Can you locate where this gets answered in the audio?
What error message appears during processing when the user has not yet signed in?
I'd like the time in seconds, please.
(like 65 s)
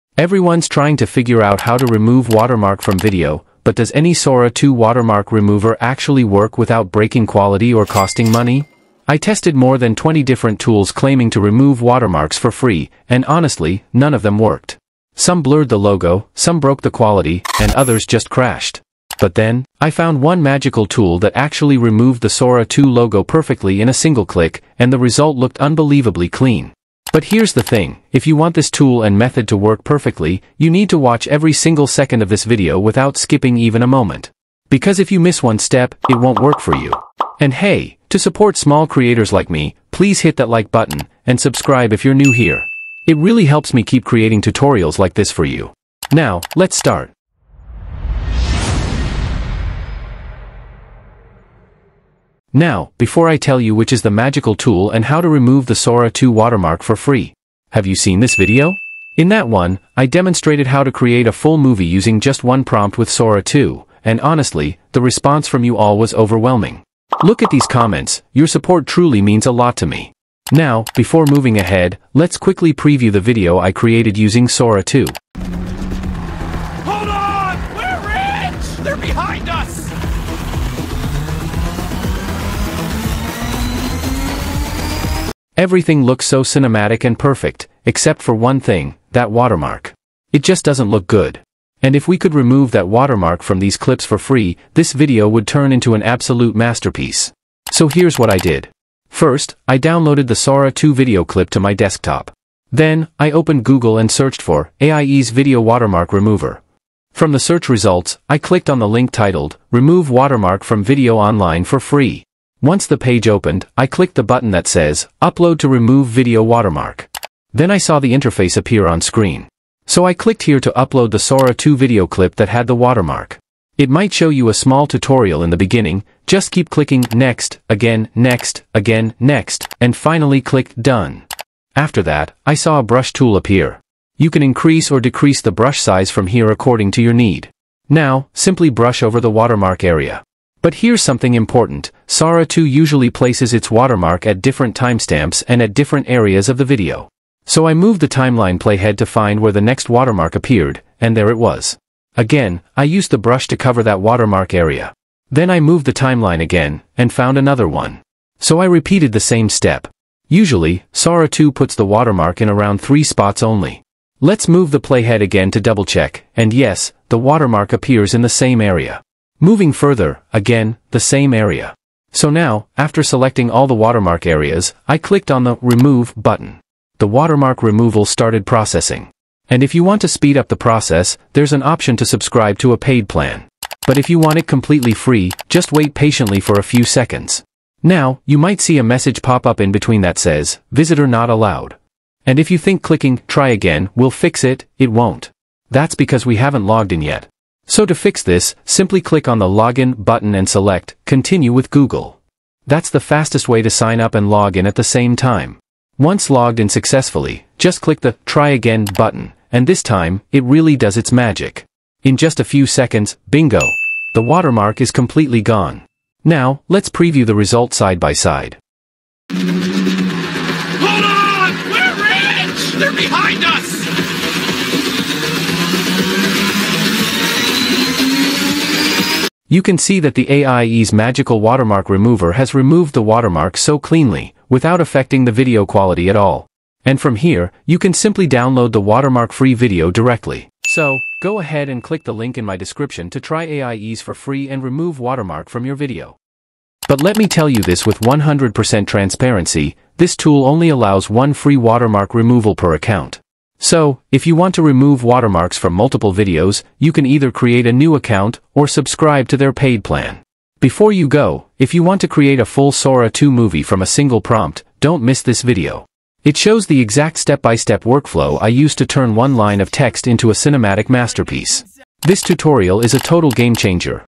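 190 s.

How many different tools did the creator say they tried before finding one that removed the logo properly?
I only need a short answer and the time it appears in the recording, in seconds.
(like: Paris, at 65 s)
more than 20, at 9 s.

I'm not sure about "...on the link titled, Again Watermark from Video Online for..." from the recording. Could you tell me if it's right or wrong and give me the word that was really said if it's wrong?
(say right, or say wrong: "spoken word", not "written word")
wrong: "Remove", not "Again".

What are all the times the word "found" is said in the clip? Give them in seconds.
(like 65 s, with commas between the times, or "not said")
19 s, 157 s.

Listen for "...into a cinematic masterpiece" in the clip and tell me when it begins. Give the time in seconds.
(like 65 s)
270 s.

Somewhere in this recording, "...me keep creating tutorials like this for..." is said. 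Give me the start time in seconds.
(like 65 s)
43 s.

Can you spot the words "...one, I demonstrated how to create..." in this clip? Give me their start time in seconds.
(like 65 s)
59 s.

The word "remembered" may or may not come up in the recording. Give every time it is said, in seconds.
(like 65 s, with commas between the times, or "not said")
not said.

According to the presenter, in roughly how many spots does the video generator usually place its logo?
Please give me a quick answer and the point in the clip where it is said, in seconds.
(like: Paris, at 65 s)
three, at 162 s.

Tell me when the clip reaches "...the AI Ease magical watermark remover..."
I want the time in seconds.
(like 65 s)
230 s.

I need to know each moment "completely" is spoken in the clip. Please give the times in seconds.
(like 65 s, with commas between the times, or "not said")
184 s, 214 s.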